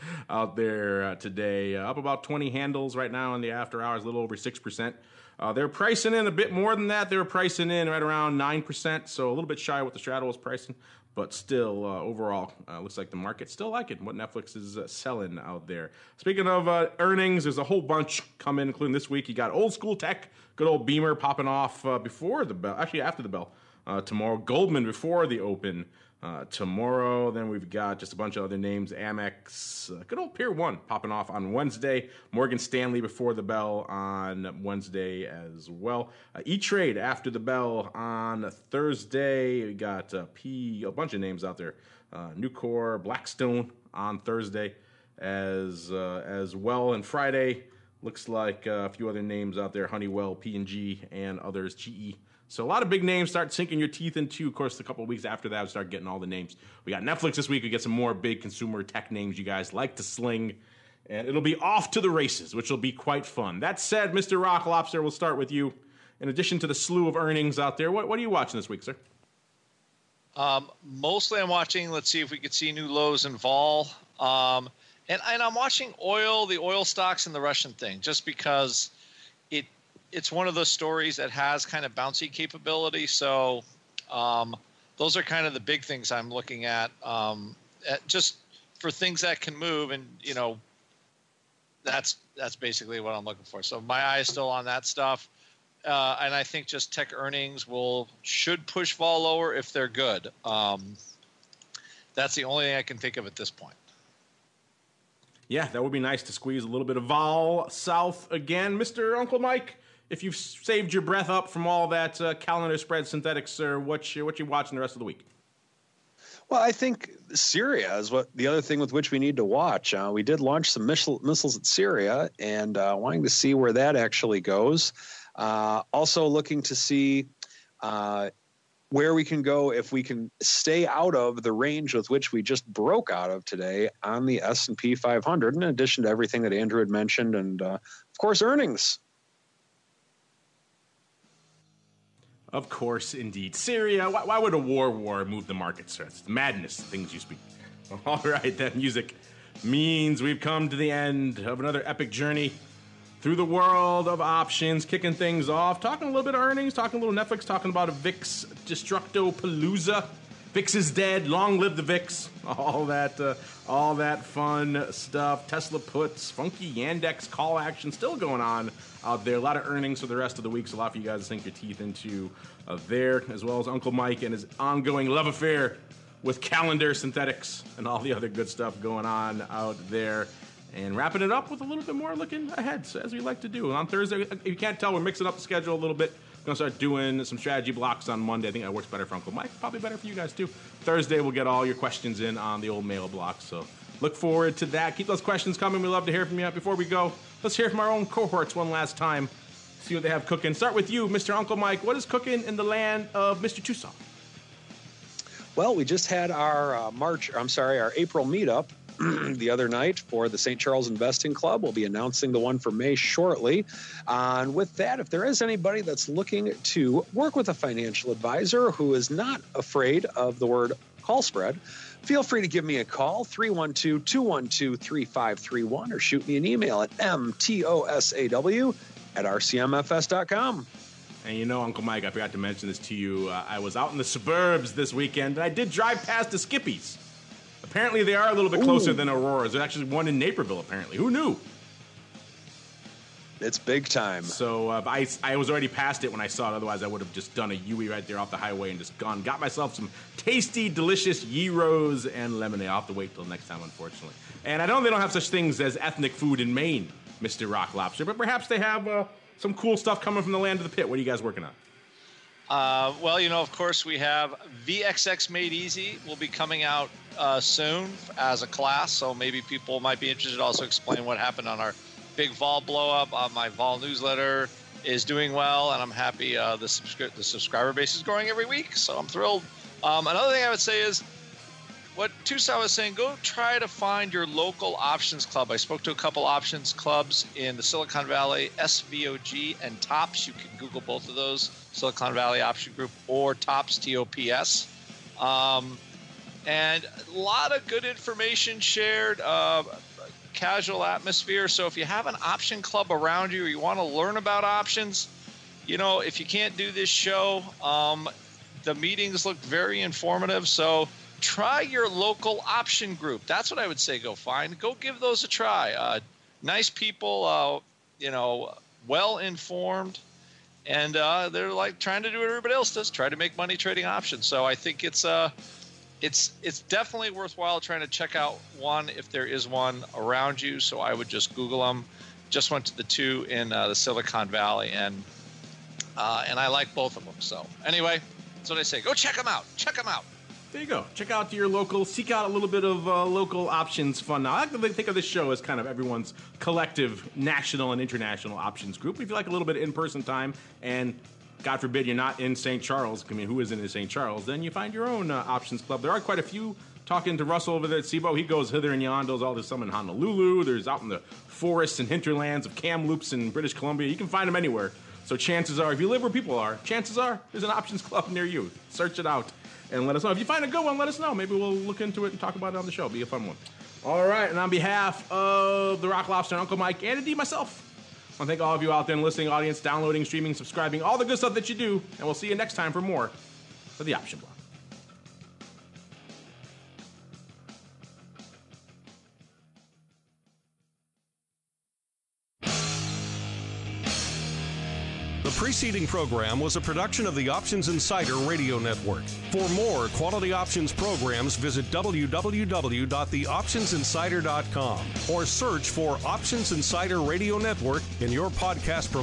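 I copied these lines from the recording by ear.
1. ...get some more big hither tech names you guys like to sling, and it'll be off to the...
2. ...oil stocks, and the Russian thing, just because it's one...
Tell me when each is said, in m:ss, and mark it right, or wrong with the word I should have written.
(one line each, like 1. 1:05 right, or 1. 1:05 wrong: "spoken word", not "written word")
1. 0:57 wrong: "consumer", not "hither"
2. 1:16 right.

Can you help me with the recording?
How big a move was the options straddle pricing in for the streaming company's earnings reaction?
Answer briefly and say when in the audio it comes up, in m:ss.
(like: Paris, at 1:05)
9%, at 0:07.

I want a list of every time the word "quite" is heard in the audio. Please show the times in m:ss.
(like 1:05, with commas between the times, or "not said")
1:02, 5:55.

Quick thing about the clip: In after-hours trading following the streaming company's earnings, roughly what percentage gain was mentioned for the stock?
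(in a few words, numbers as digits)
6%.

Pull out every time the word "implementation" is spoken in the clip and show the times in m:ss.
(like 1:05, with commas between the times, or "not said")
not said.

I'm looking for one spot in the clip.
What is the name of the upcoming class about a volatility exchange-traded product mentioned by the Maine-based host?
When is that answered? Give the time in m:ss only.
4:24.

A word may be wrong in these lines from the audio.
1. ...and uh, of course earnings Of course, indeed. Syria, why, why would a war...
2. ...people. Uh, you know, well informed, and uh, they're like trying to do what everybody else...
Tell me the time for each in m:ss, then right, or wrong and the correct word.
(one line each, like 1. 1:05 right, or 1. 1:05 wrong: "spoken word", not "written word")
1. 2:17 right
2. 5:16 right.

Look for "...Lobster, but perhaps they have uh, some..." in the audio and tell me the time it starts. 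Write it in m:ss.
4:17.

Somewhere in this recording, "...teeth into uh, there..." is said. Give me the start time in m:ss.
2:51.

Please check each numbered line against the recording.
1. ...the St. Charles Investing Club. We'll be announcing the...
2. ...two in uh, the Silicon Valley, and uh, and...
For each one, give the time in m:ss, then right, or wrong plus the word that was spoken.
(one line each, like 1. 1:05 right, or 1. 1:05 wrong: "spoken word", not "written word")
1. 3:30 right
2. 5:32 right.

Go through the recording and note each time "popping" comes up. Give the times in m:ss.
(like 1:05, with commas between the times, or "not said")
0:21, 0:30.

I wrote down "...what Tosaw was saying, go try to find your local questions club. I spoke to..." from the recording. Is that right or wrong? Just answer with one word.
wrong.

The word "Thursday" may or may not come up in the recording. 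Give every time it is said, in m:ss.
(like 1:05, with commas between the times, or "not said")
0:38, 0:44, 3:03, 3:10.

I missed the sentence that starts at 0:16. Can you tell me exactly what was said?
Speaking of uh, earnings, there's a whole bunch coming, including this week.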